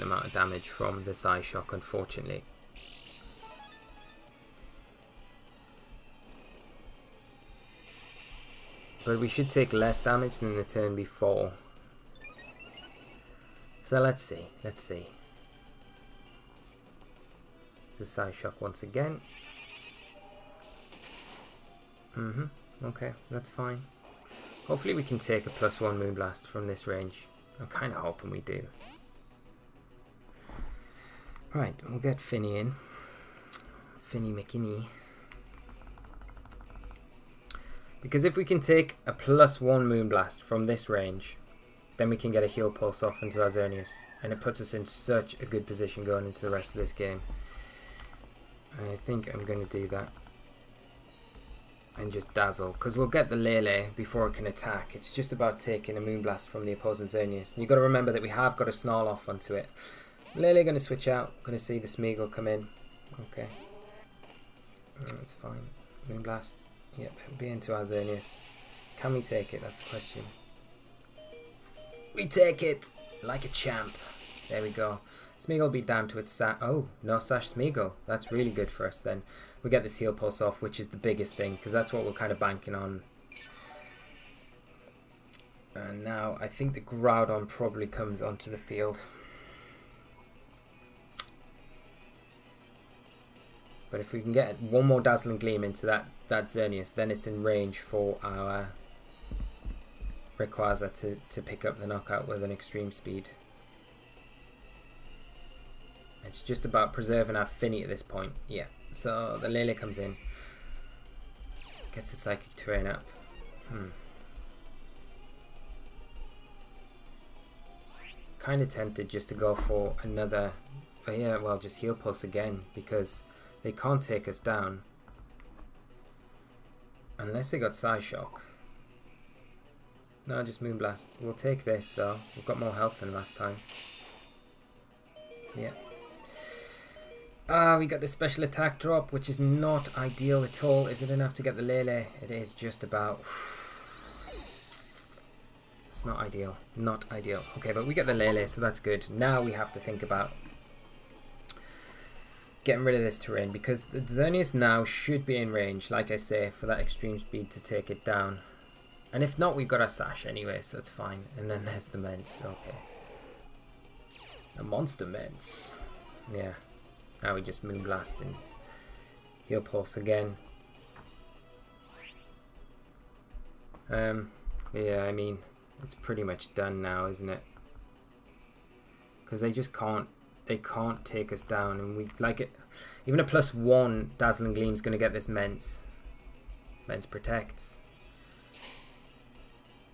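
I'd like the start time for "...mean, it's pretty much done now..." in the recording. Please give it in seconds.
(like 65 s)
175 s.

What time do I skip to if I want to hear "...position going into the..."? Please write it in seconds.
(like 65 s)
45 s.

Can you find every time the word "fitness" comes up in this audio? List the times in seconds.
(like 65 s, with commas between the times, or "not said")
not said.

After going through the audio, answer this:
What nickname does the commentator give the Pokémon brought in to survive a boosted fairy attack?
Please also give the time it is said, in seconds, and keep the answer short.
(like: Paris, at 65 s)
Finny McKinney, at 34 s.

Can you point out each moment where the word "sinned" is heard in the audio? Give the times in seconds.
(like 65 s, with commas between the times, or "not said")
not said.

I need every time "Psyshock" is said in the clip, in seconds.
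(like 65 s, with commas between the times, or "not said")
1 s, 18 s, 127 s.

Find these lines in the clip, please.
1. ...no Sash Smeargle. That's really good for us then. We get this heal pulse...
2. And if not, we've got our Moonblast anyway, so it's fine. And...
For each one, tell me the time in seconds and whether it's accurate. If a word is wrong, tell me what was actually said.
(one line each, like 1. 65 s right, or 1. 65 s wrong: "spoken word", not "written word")
1. 77 s right
2. 159 s wrong: "Sash", not "Moonblast".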